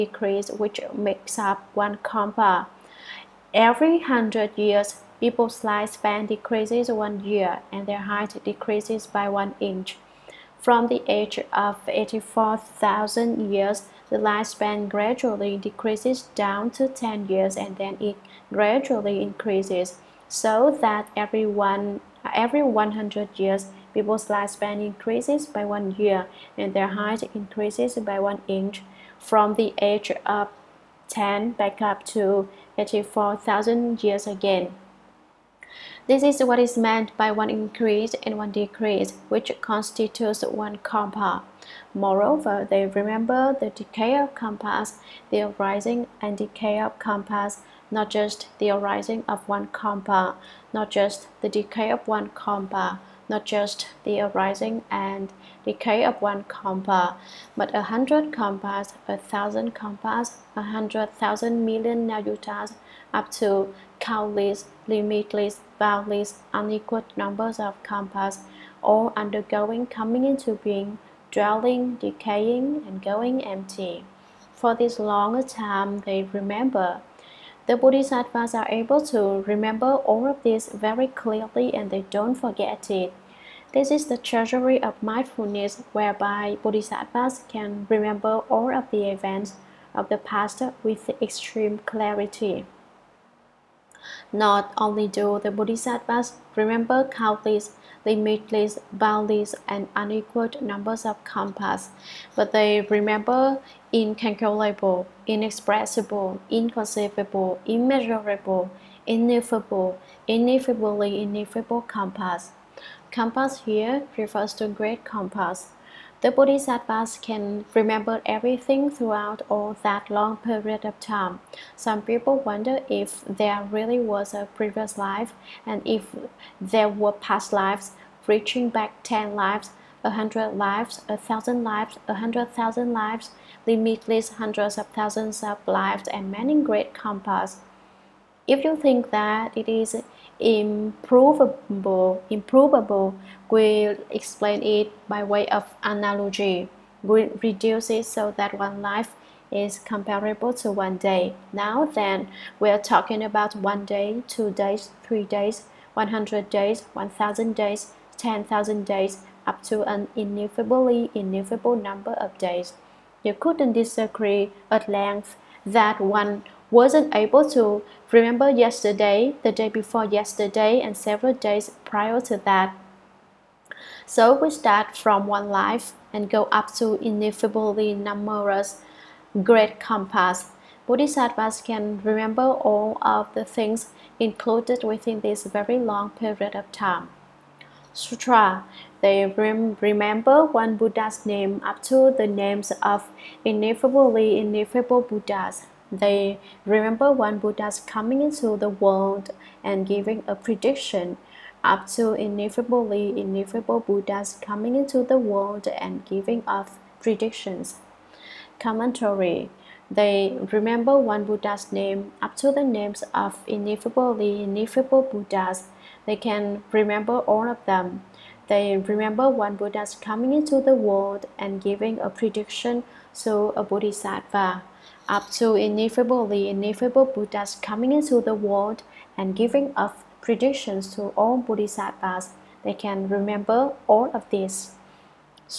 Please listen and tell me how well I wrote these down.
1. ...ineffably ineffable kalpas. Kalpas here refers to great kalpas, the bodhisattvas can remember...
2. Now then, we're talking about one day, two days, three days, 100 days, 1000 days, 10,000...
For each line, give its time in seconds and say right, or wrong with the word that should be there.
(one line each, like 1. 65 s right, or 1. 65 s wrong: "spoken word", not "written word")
1. 110 s right
2. 151 s right.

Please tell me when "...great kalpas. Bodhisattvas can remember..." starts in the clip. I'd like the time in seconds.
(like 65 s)
179 s.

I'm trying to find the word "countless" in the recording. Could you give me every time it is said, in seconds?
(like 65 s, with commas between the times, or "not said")
63 s, 97 s.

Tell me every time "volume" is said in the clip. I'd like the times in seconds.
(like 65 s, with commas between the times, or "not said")
not said.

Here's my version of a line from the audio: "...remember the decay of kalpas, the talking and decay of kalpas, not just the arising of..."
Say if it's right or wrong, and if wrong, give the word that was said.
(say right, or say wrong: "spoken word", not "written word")
wrong: "arising", not "talking".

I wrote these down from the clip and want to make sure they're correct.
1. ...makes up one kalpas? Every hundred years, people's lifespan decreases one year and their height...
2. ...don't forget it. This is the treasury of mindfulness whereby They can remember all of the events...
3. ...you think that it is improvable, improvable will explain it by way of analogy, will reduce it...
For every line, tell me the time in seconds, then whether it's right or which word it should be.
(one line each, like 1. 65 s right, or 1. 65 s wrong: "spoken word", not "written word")
1. 0 s right
2. 82 s wrong: "Bodhisattvas", not "They"
3. 138 s right.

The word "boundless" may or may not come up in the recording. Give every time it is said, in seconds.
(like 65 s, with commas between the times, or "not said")
65 s, 98 s.